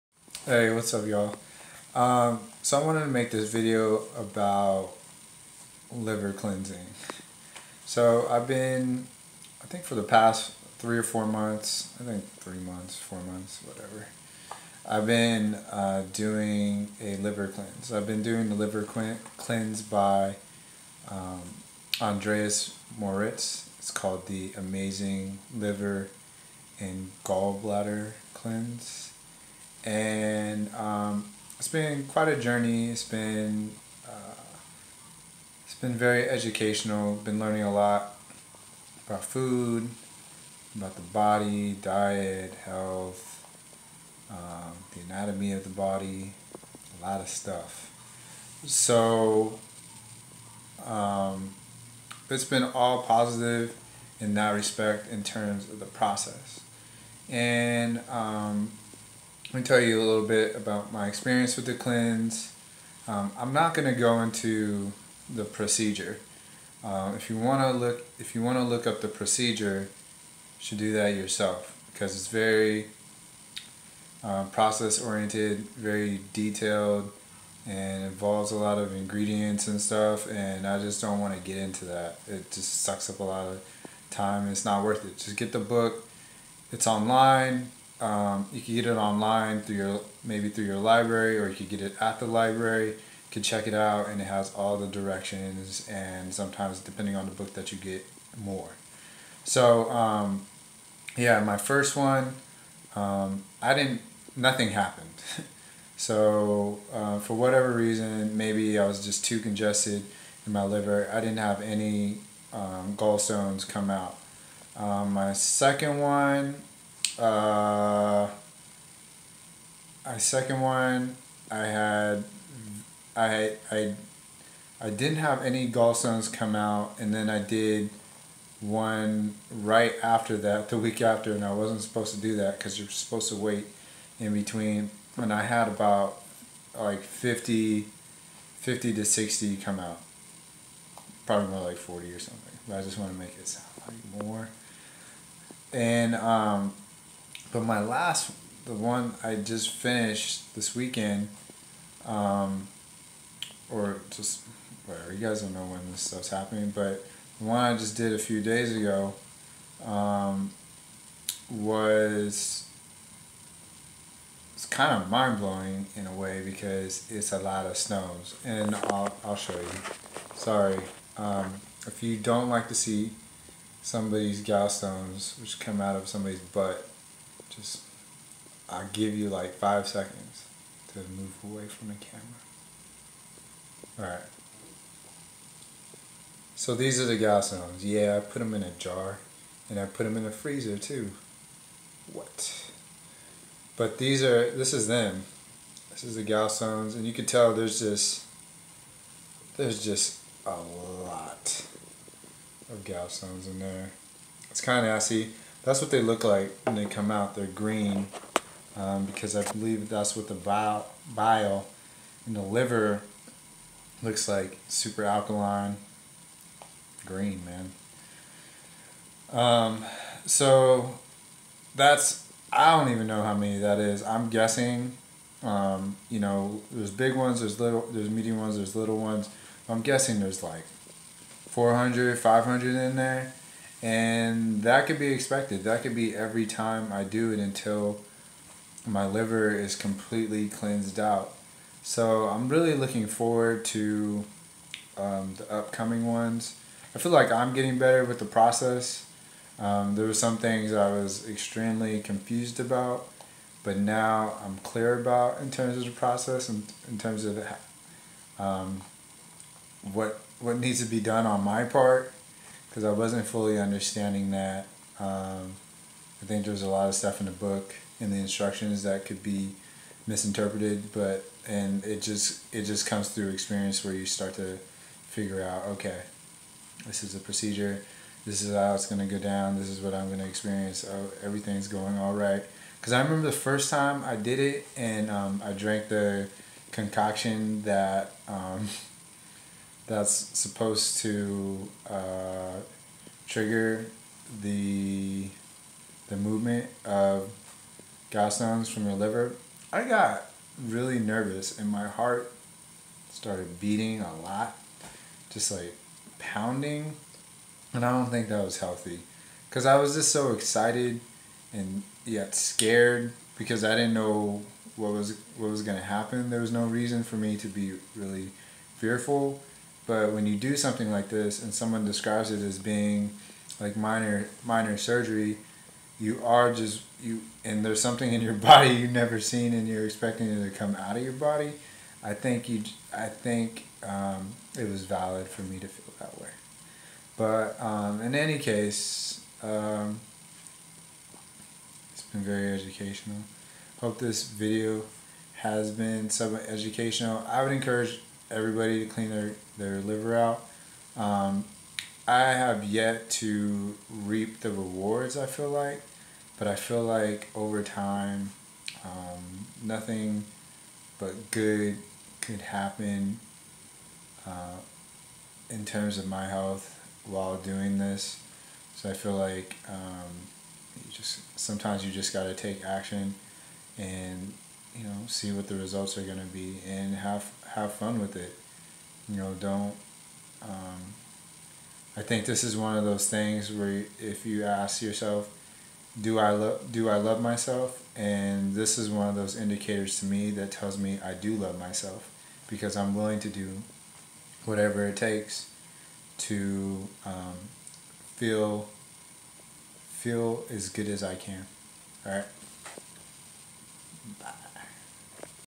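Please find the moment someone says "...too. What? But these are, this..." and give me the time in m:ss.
3:10.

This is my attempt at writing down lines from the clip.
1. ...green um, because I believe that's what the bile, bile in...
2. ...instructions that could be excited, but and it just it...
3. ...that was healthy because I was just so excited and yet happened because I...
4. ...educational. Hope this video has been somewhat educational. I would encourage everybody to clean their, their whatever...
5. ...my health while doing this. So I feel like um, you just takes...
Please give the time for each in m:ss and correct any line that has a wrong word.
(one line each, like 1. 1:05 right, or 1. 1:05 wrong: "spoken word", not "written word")
1. 3:27 right
2. 4:28 wrong: "misinterpreted", not "excited"
3. 5:08 wrong: "scared", not "happened"
4. 5:42 wrong: "liver", not "whatever"
5. 6:06 wrong: "sometimes", not "takes".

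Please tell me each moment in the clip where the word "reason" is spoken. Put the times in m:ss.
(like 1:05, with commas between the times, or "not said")
1:47, 5:16.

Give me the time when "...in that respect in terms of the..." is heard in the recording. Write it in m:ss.
0:54.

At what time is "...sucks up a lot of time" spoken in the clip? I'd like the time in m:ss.
1:22.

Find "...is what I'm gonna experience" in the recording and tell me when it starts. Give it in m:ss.
4:39.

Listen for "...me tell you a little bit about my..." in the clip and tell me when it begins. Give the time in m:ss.
0:59.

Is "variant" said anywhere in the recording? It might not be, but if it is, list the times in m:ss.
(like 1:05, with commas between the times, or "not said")
not said.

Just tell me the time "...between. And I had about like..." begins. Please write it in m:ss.
2:14.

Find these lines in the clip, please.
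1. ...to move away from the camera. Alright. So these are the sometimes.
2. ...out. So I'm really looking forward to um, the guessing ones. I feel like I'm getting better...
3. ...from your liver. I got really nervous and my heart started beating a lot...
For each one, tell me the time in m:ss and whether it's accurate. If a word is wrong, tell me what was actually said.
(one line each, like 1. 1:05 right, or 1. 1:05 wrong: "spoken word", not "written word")
1. 3:00 wrong: "gallstones", not "sometimes"
2. 4:00 wrong: "upcoming", not "guessing"
3. 4:58 right.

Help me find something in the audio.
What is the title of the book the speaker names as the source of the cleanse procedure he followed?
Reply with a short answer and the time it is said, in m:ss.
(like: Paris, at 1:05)
The Amazing Liver and Gallbladder Cleanse, at 0:24.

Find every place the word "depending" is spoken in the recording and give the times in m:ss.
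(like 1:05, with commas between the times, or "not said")
1:36.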